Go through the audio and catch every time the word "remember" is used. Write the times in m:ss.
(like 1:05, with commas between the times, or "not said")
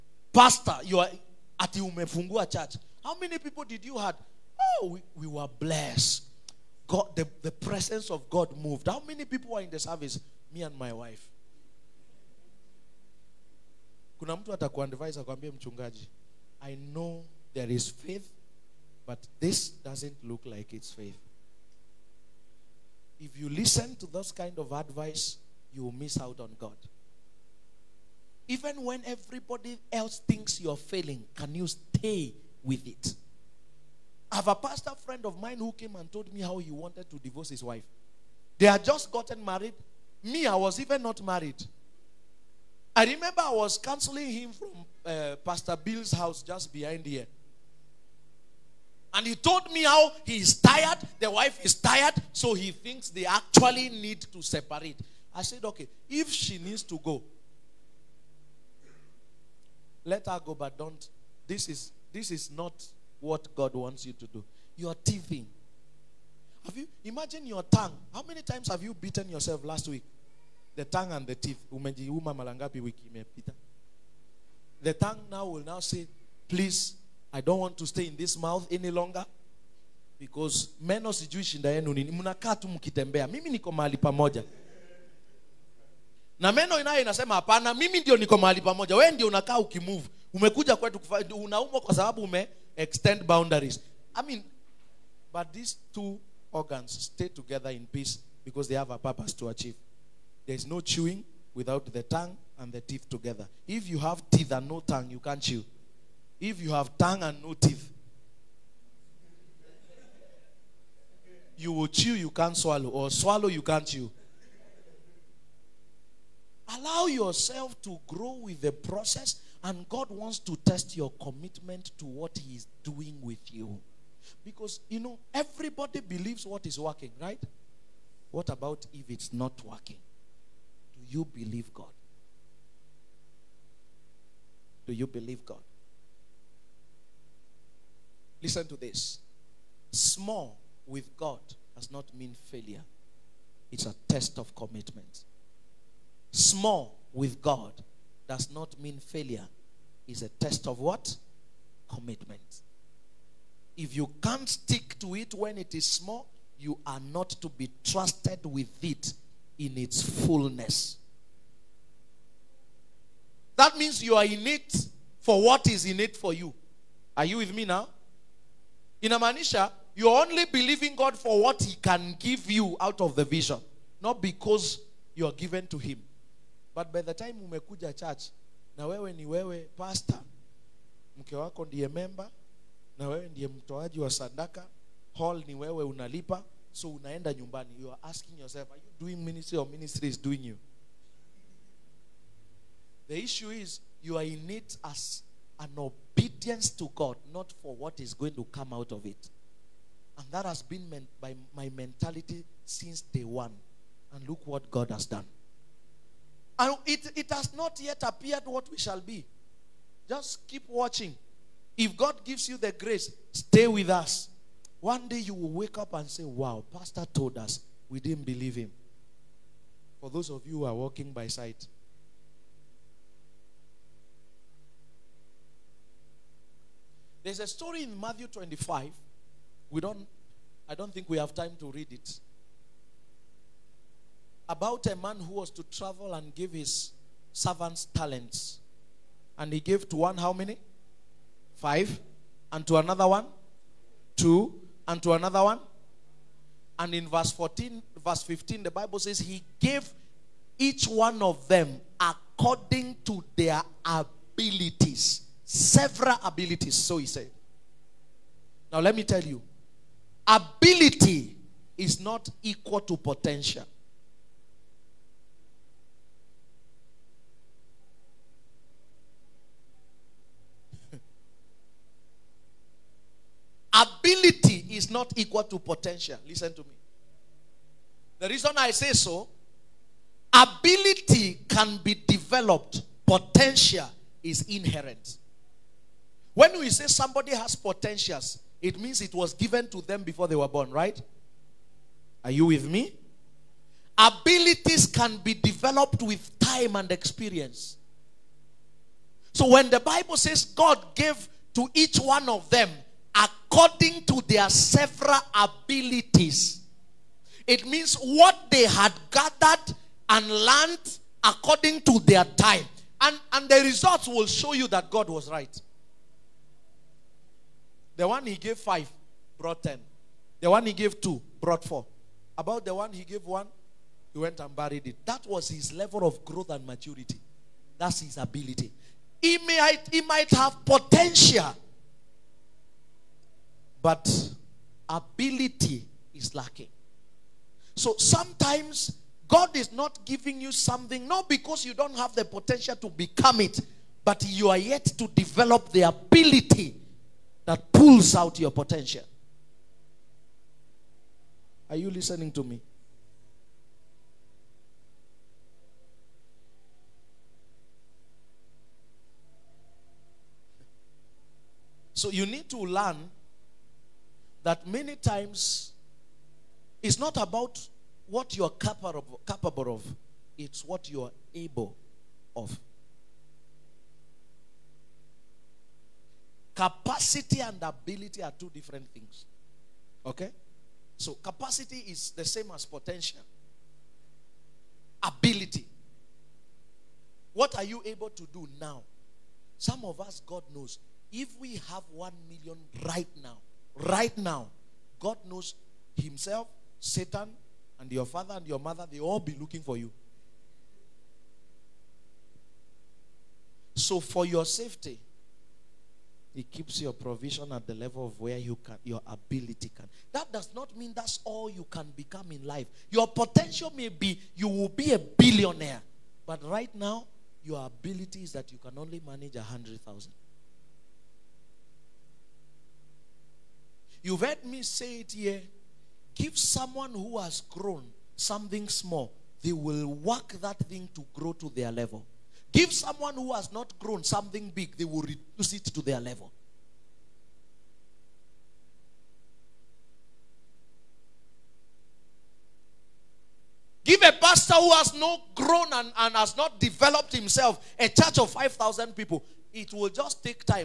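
0:43.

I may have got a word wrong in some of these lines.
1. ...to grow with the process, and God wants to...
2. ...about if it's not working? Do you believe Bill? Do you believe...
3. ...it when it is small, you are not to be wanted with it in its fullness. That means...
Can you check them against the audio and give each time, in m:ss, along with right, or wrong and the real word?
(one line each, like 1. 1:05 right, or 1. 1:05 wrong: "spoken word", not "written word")
1. 1:57 right
2. 2:08 wrong: "God", not "Bill"
3. 2:35 wrong: "trusted", not "wanted".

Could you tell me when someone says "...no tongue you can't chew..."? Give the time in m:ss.
1:44.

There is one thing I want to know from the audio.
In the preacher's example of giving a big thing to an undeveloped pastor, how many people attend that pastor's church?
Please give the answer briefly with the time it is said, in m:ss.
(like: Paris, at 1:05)
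5,000, at 7:28.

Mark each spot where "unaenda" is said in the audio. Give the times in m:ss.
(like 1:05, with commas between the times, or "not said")
3:06.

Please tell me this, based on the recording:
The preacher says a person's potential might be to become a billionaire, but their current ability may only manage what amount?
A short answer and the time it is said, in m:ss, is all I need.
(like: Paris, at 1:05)
100,000, at 6:59.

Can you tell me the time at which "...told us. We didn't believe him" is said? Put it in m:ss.
3:37.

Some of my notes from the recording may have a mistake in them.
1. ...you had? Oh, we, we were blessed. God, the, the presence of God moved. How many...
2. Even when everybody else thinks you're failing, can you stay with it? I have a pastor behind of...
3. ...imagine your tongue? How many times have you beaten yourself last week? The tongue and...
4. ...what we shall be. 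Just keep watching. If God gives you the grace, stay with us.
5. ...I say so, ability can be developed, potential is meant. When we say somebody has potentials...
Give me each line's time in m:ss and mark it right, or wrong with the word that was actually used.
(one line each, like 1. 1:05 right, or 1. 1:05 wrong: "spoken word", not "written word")
1. 0:03 right
2. 0:28 wrong: "friend", not "behind"
3. 1:07 right
4. 3:28 right
5. 4:38 wrong: "inherent", not "meant".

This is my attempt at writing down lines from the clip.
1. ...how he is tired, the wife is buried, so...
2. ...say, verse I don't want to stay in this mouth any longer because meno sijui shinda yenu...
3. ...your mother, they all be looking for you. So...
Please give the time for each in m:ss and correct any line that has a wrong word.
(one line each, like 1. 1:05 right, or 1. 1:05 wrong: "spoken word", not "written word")
1. 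0:49 wrong: "tired", not "buried"
2. 1:15 wrong: "please", not "verse"
3. 6:38 right.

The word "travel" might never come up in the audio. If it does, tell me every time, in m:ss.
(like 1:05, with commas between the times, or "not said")
3:55.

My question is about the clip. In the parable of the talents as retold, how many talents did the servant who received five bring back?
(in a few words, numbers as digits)
10.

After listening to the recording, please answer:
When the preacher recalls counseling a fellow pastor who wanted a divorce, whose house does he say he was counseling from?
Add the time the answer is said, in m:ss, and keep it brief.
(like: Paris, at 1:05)
Pastor Bill's house, at 0:45.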